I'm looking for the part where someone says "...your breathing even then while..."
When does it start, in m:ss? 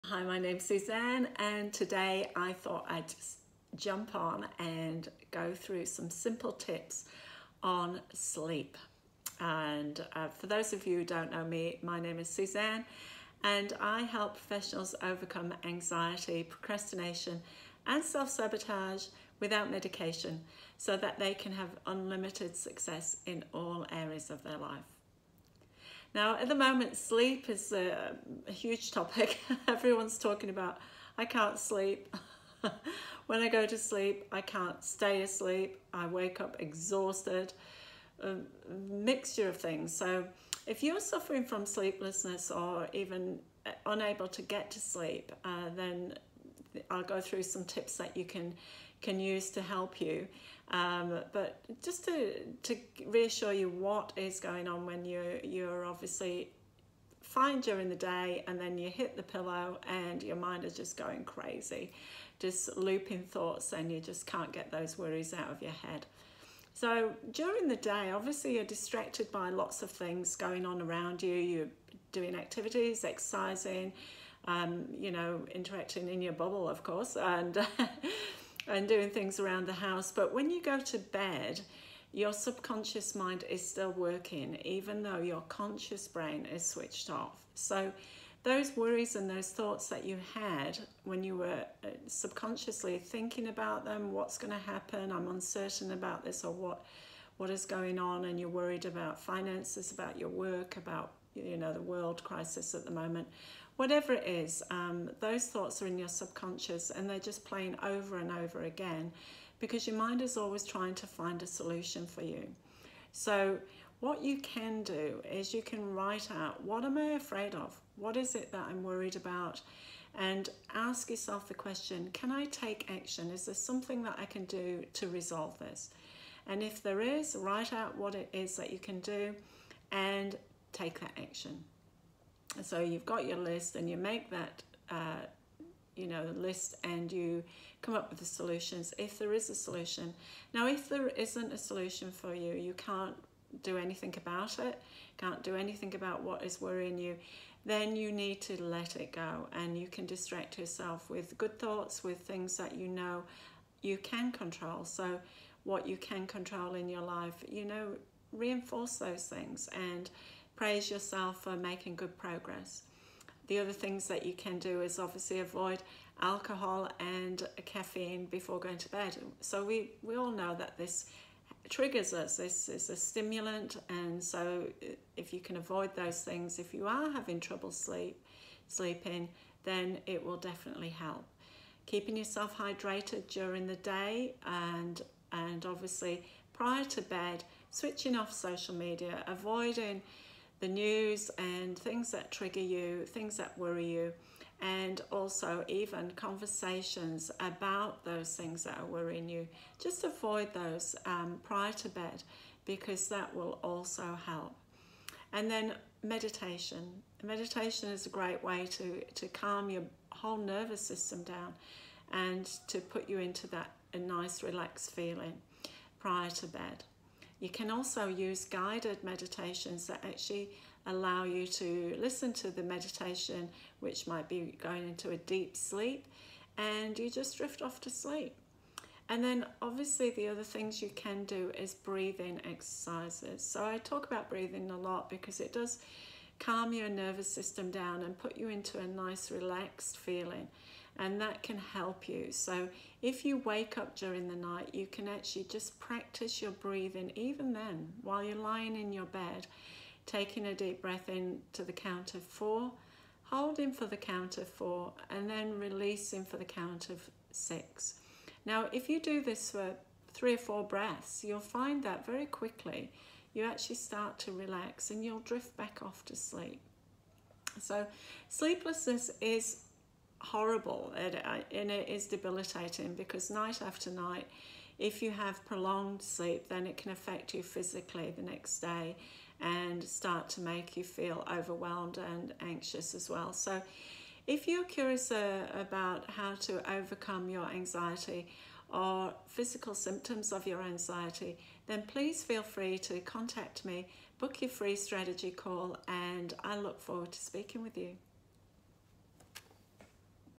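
4:06.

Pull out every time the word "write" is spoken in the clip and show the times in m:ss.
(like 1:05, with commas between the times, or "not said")
1:55, 2:07.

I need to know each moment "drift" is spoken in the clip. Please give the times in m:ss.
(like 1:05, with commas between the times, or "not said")
3:47, 4:25.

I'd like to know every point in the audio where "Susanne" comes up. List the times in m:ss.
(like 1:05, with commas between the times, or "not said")
0:00, 0:12.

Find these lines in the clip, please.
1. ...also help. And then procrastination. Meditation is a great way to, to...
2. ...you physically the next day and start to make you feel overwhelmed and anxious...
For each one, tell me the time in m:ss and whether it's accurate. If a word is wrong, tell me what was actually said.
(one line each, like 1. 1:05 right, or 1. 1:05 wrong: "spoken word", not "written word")
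1. 3:23 wrong: "meditation", not "procrastination"
2. 4:37 right.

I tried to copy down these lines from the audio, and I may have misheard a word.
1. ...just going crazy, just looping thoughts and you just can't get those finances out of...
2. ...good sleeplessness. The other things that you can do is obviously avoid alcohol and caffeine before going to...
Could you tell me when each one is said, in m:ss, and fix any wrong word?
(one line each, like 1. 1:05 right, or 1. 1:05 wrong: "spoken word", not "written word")
1. 1:00 wrong: "worries", not "finances"
2. 2:41 wrong: "progress", not "sleeplessness".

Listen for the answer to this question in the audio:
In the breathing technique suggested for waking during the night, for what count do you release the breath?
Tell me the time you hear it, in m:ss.
4:17.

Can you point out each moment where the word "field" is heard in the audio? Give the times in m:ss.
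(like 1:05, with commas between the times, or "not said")
not said.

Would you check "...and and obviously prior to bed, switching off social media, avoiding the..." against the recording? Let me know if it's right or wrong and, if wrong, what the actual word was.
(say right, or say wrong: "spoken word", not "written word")
right.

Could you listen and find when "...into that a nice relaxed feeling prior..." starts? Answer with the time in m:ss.
3:33.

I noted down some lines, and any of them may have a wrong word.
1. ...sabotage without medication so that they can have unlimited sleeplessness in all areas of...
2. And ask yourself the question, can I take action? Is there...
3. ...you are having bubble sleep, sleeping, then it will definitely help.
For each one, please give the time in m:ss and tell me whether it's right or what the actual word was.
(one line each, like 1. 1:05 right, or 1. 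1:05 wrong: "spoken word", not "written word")
1. 0:18 wrong: "success", not "sleeplessness"
2. 2:00 right
3. 2:56 wrong: "trouble", not "bubble".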